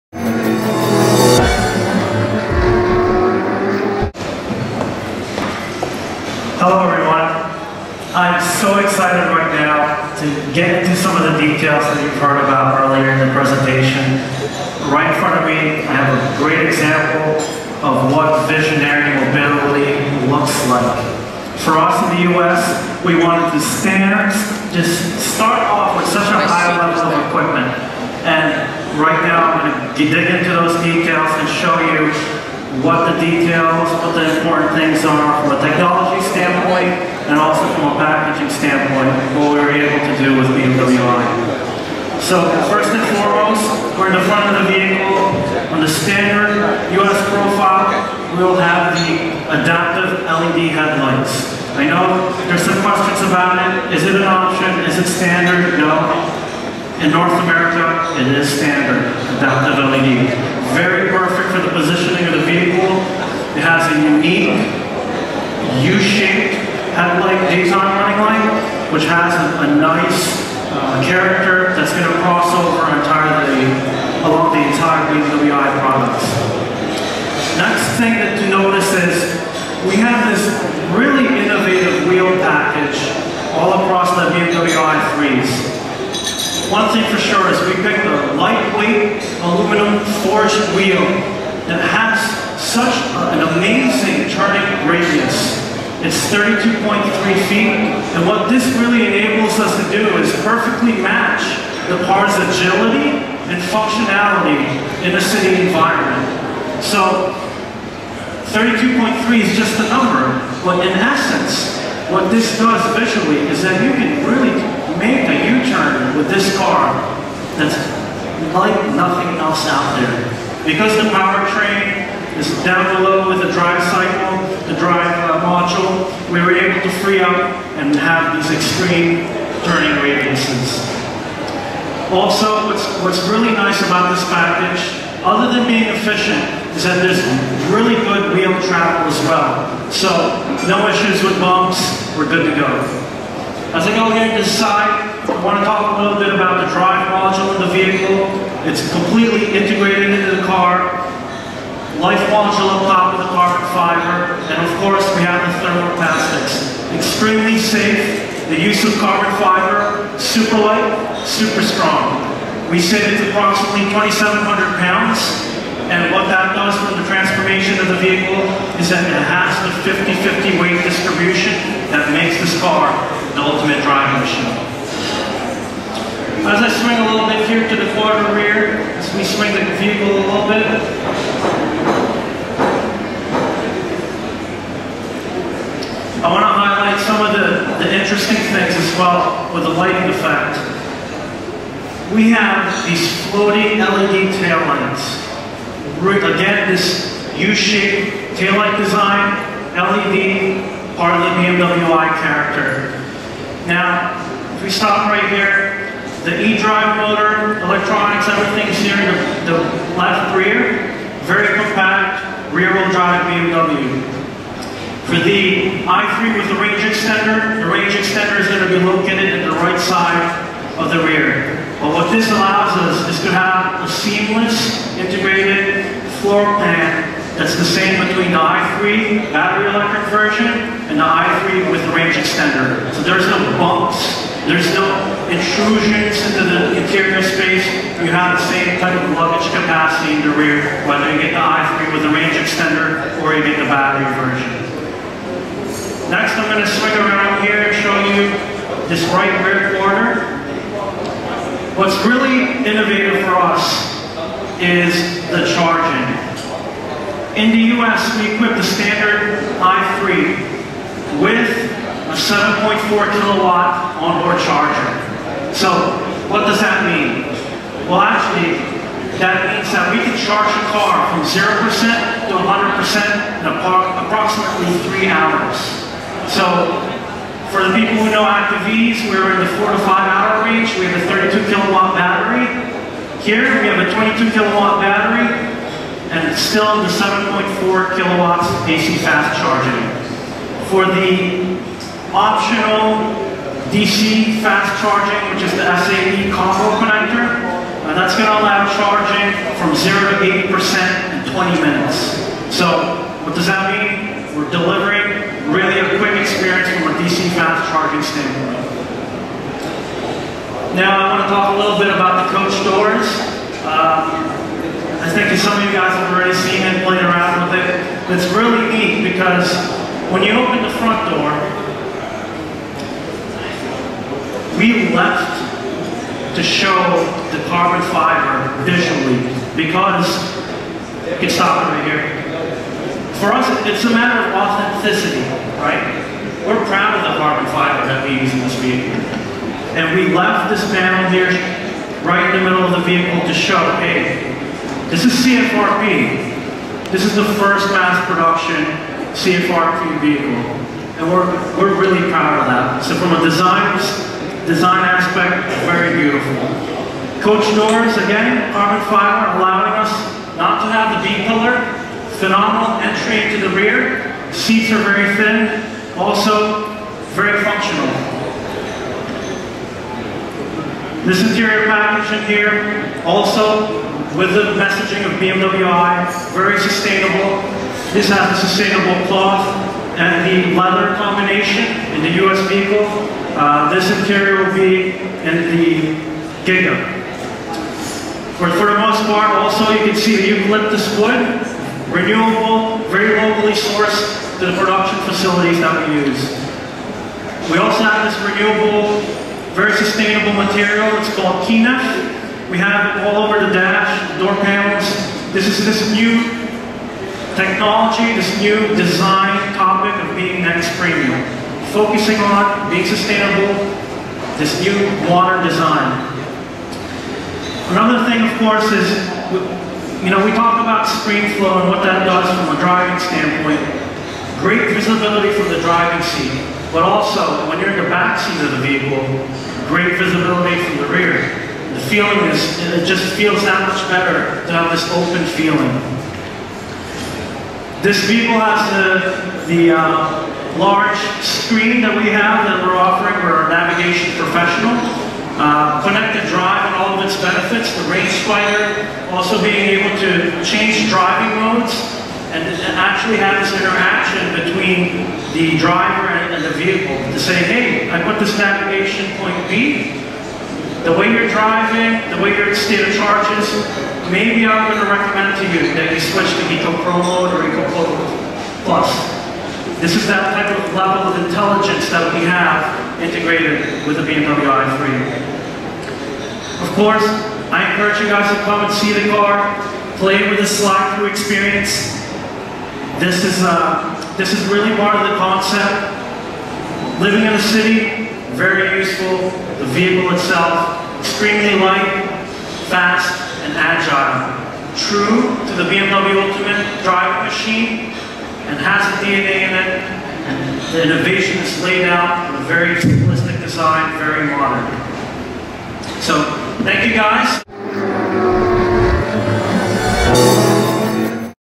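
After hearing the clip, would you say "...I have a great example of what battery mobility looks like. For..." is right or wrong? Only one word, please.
wrong.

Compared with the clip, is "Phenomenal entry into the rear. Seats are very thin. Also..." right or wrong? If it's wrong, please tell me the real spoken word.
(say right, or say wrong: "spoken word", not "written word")
right.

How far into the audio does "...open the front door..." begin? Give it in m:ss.
5:20.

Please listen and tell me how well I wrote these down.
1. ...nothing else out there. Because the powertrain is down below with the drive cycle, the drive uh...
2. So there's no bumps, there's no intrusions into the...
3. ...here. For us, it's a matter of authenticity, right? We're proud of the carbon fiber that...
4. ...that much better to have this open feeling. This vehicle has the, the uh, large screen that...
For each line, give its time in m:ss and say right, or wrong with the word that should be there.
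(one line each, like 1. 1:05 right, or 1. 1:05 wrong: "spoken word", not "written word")
1. 1:58 right
2. 3:52 right
3. 5:31 right
4. 7:13 right.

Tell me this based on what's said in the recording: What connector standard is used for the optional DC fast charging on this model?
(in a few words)
SAE combo connector.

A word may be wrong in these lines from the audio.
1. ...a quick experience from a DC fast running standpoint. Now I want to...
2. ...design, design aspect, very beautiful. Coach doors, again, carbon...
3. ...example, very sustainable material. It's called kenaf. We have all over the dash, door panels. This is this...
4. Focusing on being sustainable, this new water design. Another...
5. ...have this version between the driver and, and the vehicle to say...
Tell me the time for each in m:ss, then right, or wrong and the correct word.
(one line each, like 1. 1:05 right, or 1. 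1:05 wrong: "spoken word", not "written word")
1. 5:05 wrong: "charging", not "running"
2. 5:53 right
3. 6:38 wrong: "renewable", not "example"
4. 6:51 right
5. 7:33 wrong: "interaction", not "version".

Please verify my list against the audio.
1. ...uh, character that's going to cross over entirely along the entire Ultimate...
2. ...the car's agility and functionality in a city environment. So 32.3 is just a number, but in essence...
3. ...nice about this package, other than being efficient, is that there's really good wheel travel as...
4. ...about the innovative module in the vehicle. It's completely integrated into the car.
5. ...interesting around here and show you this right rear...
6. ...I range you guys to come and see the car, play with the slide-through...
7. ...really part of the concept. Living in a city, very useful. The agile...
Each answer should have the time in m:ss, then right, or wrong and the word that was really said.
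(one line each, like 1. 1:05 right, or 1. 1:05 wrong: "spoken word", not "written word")
1. 1:10 wrong: "BMW", not "Ultimate"
2. 1:41 right
3. 2:13 right
4. 2:26 wrong: "drive", not "innovative"
5. 4:06 wrong: "swing", not "interesting"
6. 7:57 wrong: "encourage", not "range"
7. 8:04 wrong: "vehicle", not "agile".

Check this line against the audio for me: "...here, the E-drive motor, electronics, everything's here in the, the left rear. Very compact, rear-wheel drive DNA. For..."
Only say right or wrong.
wrong.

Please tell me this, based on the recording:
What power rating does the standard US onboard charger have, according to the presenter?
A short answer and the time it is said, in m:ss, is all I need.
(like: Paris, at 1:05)
7.4 kilowatt, at 4:22.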